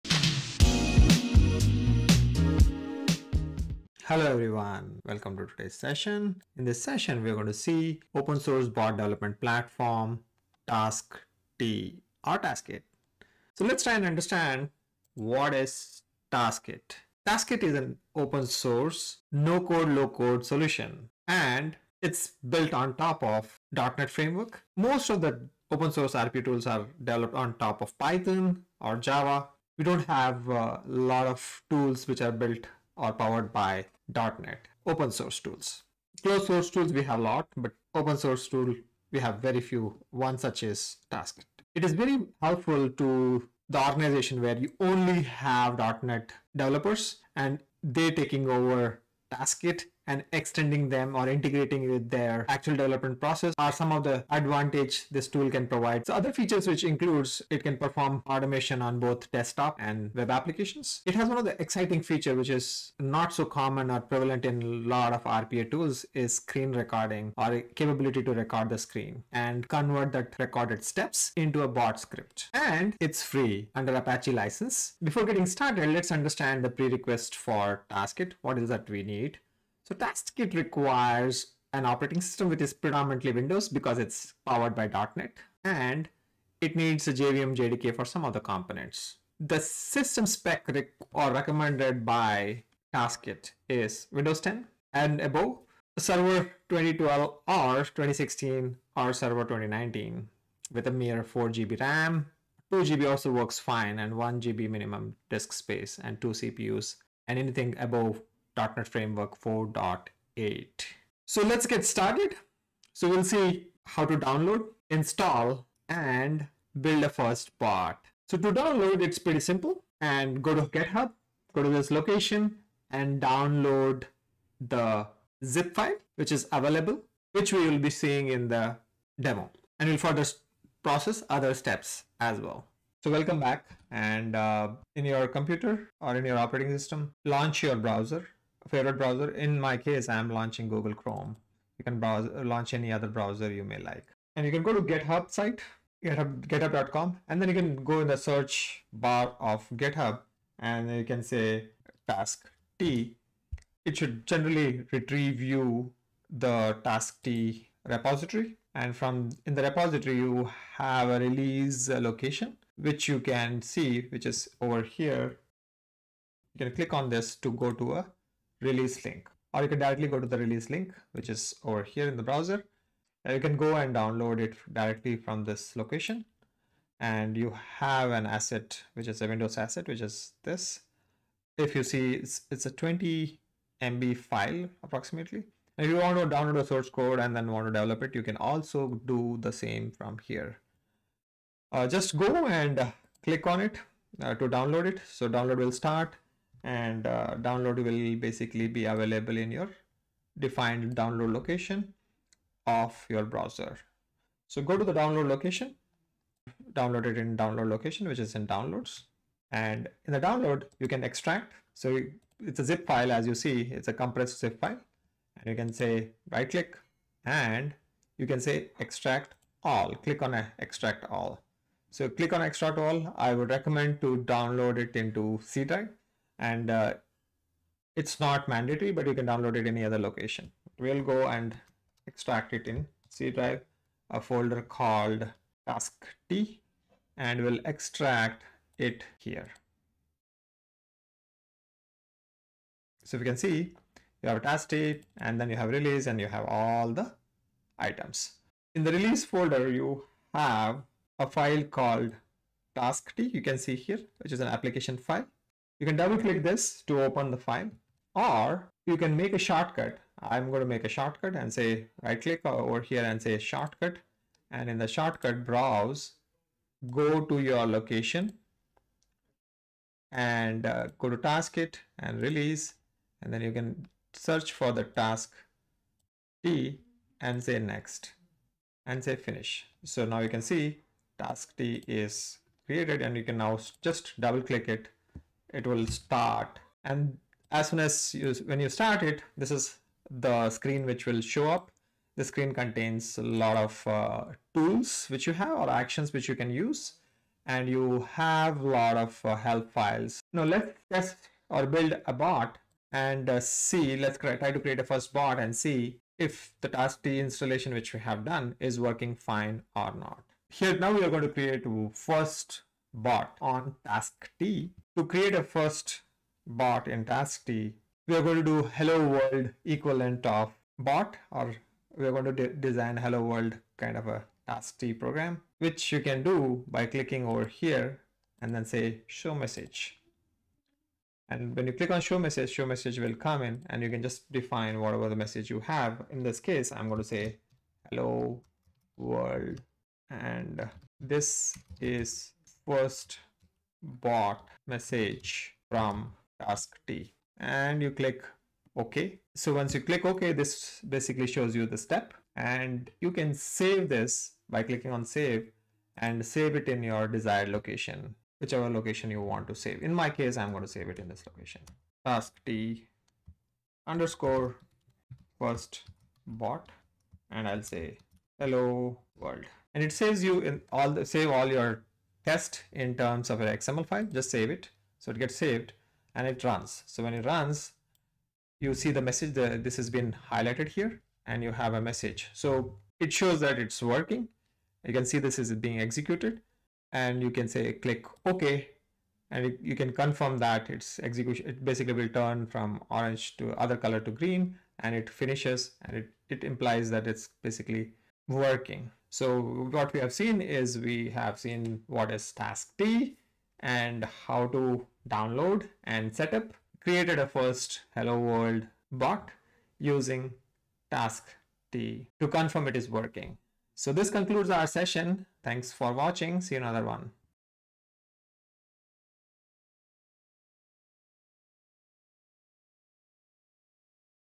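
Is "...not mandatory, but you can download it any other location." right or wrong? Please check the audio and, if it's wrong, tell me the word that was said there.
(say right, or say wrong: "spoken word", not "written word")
right.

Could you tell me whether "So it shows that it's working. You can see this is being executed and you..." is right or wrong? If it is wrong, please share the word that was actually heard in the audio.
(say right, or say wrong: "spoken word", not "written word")
right.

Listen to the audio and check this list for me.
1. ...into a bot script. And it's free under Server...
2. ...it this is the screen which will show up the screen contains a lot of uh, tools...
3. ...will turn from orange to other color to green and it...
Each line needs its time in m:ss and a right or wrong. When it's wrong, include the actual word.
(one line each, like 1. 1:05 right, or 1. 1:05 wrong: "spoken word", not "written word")
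1. 1:11 wrong: "Apache", not "Server"
2. 4:49 right
3. 6:31 right.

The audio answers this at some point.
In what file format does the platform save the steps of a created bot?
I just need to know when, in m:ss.
6:13.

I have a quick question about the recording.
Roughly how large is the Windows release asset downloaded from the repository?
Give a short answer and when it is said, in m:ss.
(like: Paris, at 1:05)
20 MB, at 3:02.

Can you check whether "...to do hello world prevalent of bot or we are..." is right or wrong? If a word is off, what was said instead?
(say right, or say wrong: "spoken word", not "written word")
wrong: "equivalent", not "prevalent".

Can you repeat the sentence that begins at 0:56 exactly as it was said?
So other features which includes it can perform automation on both desktop and web applications.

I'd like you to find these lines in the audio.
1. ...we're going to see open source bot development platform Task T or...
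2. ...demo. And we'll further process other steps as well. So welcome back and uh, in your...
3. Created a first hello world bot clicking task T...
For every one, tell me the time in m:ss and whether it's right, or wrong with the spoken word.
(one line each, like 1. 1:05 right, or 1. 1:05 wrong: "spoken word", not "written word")
1. 0:07 right
2. 2:09 right
3. 6:46 wrong: "using", not "clicking".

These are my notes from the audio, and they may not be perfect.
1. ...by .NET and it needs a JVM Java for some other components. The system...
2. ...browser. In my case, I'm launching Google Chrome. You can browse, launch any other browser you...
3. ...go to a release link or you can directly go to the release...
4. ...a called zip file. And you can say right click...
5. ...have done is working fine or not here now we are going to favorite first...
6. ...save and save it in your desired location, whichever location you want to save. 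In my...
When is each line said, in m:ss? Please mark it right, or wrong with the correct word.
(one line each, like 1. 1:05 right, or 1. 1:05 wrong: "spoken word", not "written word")
1. 1:24 wrong: "JDK", not "Java"
2. 2:18 right
3. 2:47 right
4. 3:33 wrong: "compressed", not "called"
5. 5:07 wrong: "create", not "favorite"
6. 5:55 right.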